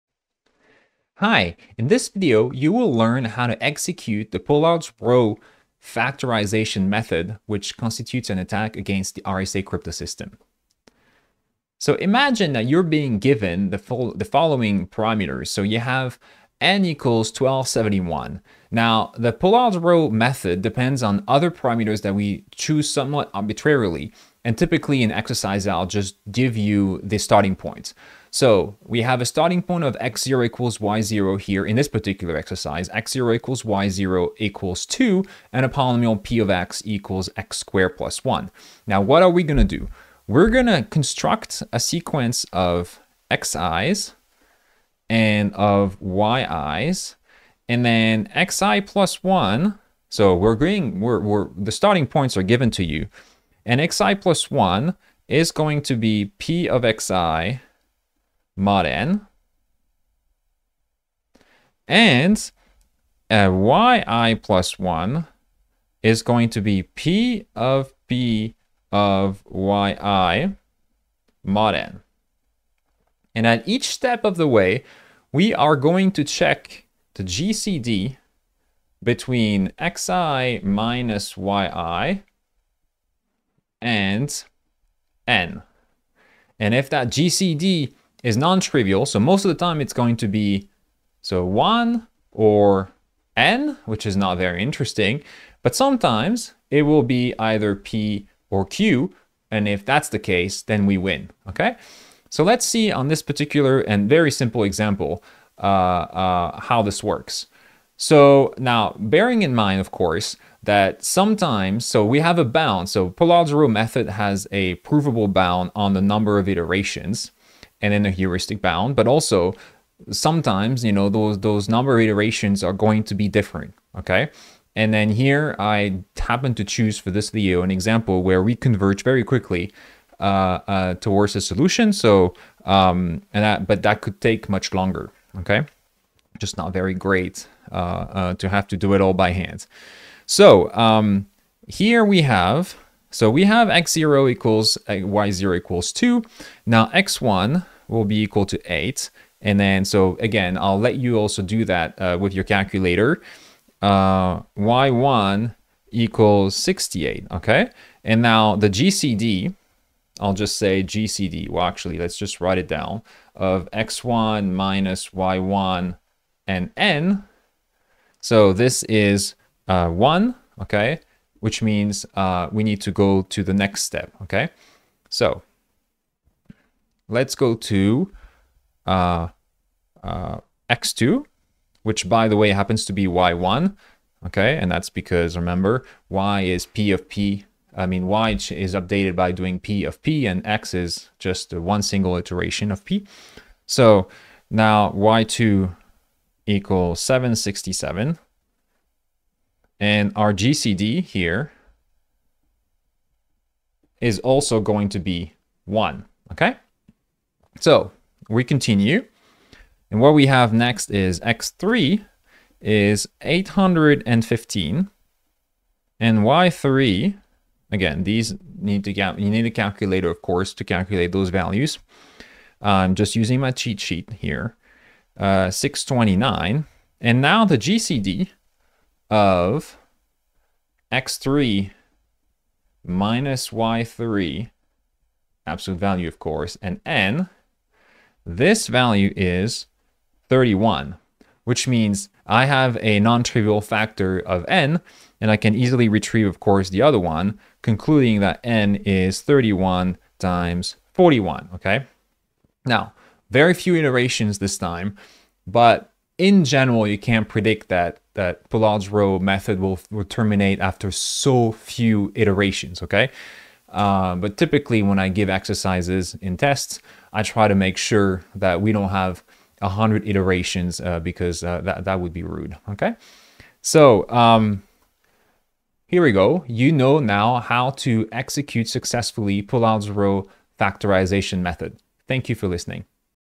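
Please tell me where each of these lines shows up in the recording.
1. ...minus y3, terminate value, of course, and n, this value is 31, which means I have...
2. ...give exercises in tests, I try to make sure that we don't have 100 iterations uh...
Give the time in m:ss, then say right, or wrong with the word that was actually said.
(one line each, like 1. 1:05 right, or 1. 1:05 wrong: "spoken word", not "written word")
1. 3:52 wrong: "absolute", not "terminate"
2. 4:25 right.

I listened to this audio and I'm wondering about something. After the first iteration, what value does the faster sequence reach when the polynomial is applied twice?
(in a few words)
68.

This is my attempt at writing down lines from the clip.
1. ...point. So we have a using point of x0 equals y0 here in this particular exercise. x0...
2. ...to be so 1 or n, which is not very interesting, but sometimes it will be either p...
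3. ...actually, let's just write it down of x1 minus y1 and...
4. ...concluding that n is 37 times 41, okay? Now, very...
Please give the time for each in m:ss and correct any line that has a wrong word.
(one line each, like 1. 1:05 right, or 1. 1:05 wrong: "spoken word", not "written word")
1. 0:27 wrong: "starting", not "using"
2. 1:30 right
3. 2:41 right
4. 4:07 wrong: "31", not "37".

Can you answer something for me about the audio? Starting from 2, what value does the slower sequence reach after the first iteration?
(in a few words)
8.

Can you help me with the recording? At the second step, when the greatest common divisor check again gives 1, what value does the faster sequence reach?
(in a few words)
767.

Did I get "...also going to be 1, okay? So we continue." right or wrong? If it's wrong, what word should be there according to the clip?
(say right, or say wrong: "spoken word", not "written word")
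right.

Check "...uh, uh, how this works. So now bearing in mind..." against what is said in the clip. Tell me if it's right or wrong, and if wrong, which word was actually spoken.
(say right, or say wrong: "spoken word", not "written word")
right.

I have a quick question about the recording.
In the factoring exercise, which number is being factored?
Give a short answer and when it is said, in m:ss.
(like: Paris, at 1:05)
1271, at 0:17.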